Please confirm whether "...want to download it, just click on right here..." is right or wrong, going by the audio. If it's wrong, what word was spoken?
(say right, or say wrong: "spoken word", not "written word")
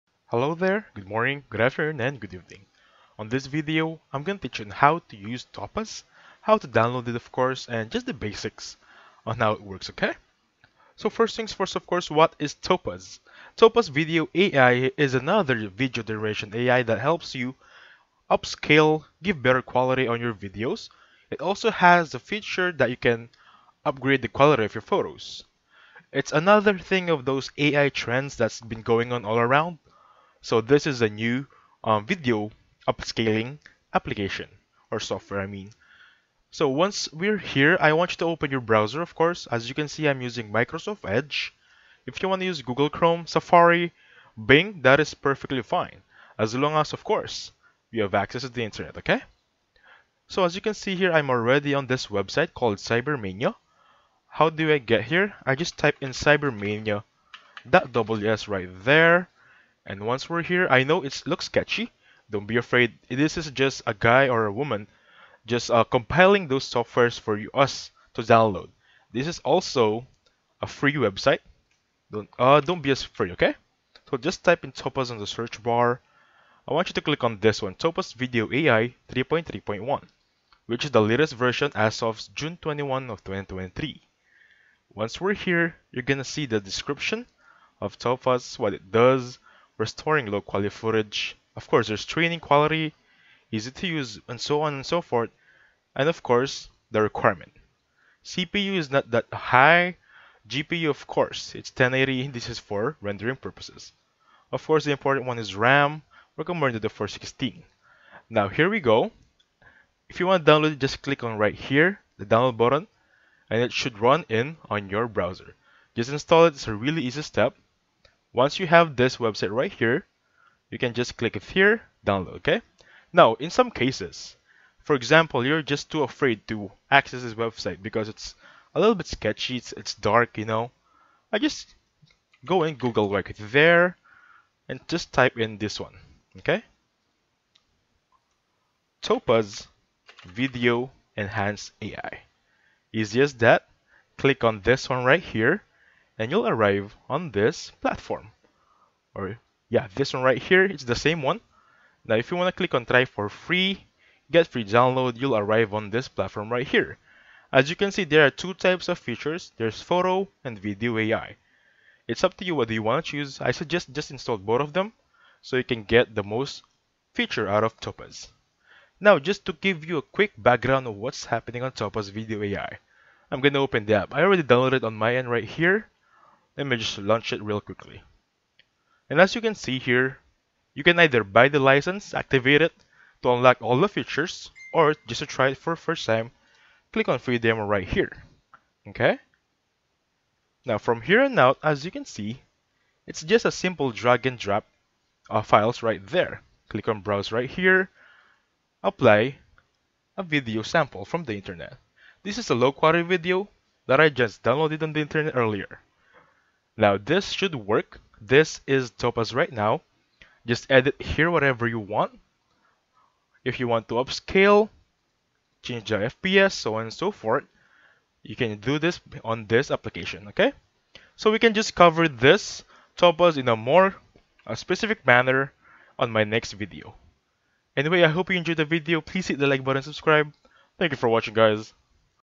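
right.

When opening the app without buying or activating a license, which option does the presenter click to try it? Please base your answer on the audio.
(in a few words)
free demo.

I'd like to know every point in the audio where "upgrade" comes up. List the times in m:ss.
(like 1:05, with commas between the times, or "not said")
0:23.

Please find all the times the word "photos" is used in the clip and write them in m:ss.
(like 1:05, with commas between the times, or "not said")
0:24, 2:39.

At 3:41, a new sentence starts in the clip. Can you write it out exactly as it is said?
So we can just cover this Topaz in a more a specific manner on my next video.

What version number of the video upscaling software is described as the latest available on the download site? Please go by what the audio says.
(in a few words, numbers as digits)
3.3.1.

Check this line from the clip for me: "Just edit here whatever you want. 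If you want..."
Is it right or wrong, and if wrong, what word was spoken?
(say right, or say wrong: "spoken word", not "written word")
right.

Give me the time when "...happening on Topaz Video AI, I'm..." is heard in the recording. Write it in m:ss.
2:51.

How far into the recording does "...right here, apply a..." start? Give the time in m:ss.
3:17.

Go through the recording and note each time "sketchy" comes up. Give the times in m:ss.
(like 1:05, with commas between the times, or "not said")
1:01, 2:09.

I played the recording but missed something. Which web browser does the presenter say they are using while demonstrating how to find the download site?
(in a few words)
Microsoft Edge.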